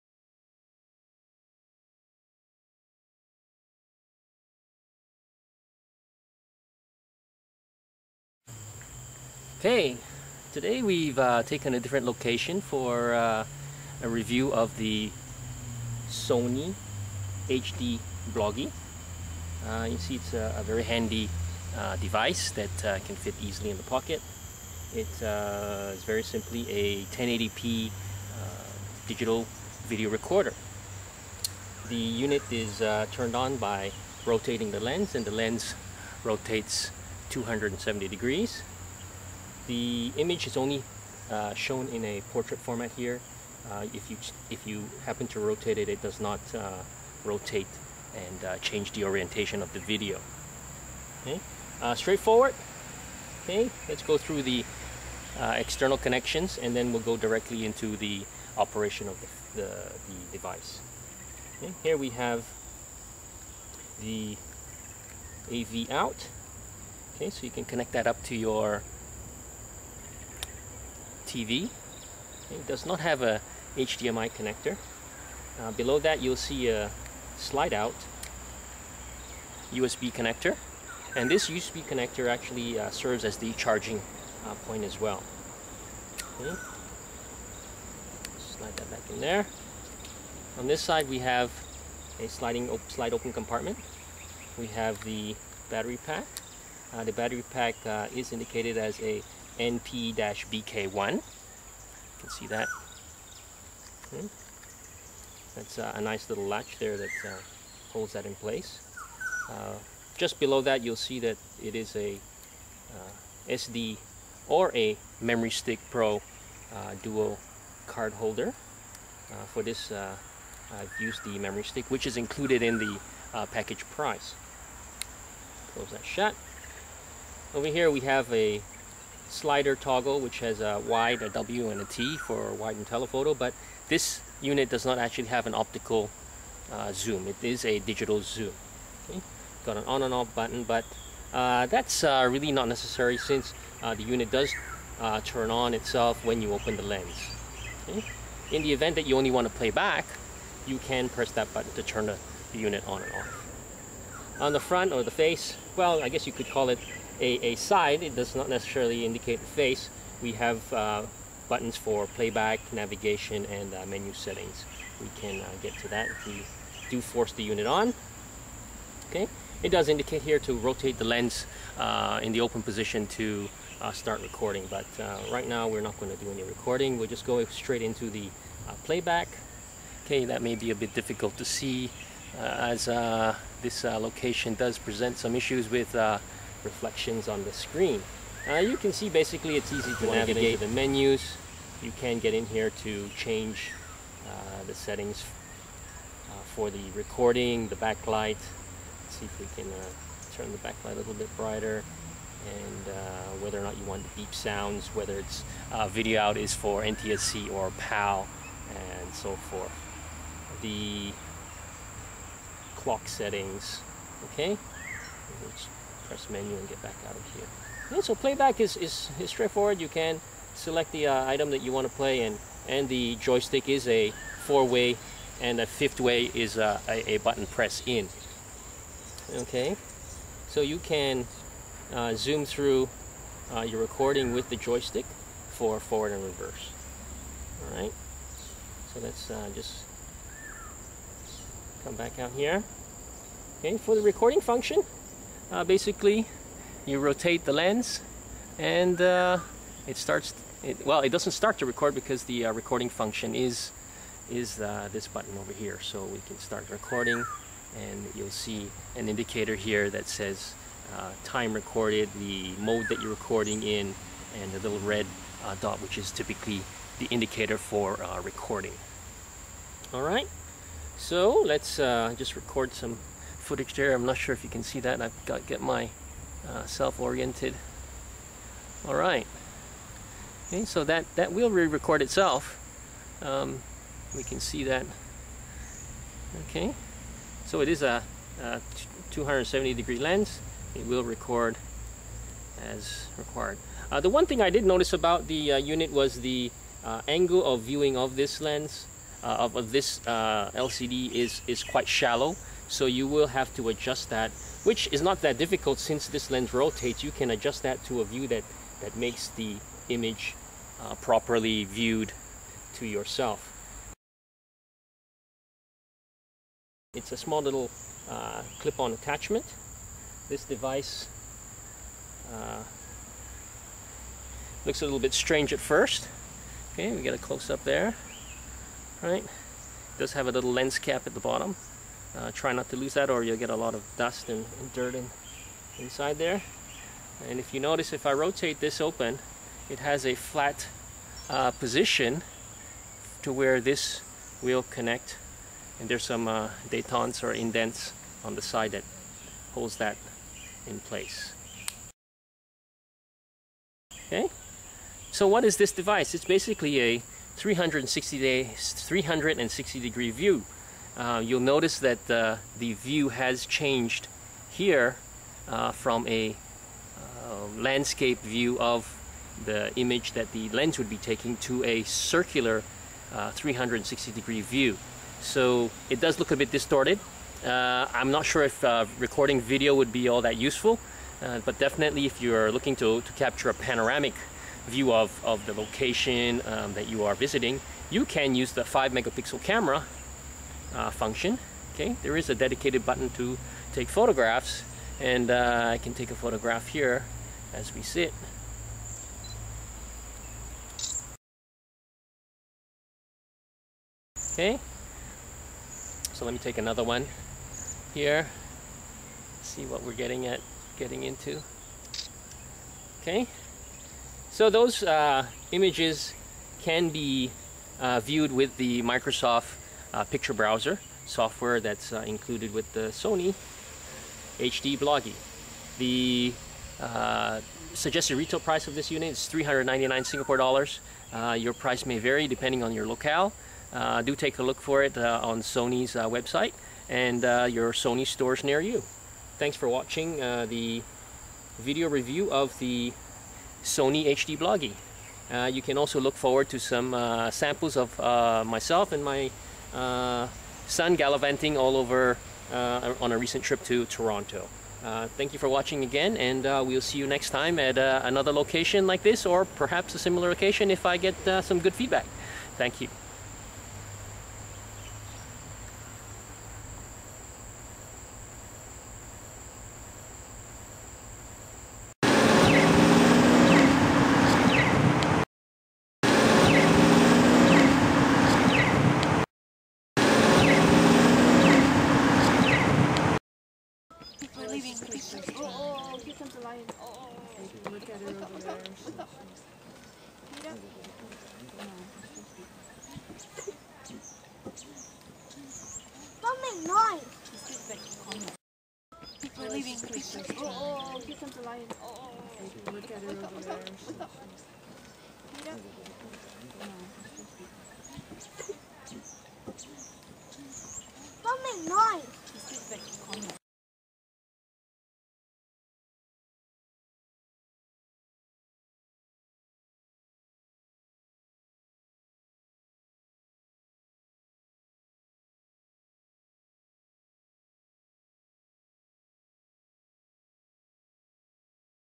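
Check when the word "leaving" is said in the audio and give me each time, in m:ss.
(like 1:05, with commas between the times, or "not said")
8:04, 8:19.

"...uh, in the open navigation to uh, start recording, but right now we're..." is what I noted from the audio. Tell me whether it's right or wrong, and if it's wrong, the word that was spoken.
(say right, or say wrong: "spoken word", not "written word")
wrong: "position", not "navigation".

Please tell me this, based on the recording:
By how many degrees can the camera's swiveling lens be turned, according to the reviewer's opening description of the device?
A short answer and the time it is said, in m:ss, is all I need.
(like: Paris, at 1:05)
270 degrees, at 0:37.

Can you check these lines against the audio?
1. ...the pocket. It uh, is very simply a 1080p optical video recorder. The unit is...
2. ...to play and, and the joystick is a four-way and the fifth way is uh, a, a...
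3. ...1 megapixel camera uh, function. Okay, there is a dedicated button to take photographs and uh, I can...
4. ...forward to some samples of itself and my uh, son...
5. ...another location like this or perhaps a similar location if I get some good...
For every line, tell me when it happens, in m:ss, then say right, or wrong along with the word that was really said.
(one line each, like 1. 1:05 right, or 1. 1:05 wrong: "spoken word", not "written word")
1. 0:23 wrong: "digital", not "optical"
2. 3:41 right
3. 6:28 wrong: "5", not "1"
4. 7:26 wrong: "myself", not "itself"
5. 7:37 right.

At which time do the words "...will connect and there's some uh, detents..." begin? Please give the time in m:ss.
5:44.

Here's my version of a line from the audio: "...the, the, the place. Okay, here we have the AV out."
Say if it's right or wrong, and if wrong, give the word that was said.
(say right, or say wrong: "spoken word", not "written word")
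wrong: "device", not "place".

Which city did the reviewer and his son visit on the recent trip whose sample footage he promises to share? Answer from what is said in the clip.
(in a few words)
Toronto.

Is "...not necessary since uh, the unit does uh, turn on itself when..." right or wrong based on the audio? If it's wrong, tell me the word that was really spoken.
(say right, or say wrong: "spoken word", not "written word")
right.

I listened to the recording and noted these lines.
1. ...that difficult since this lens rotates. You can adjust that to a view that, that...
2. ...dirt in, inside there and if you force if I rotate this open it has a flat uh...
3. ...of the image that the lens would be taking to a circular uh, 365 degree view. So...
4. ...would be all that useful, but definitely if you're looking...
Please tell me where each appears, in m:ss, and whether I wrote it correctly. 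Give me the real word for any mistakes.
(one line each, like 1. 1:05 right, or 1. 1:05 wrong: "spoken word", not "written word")
1. 5:05 right
2. 5:34 wrong: "notice", not "force"
3. 6:08 wrong: "360", not "365"
4. 6:19 right.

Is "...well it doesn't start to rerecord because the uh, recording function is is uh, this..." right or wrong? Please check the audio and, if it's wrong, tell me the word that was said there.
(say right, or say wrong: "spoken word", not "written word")
wrong: "record", not "rerecord".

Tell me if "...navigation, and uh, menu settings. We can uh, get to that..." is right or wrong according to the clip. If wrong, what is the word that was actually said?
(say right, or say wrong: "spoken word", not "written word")
right.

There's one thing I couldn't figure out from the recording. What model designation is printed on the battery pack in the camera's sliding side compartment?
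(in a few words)
NP-BK1.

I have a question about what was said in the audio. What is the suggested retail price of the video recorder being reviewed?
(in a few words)
399 Singapore dollars.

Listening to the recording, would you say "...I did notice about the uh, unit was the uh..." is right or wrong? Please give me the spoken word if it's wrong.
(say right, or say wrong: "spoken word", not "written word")
right.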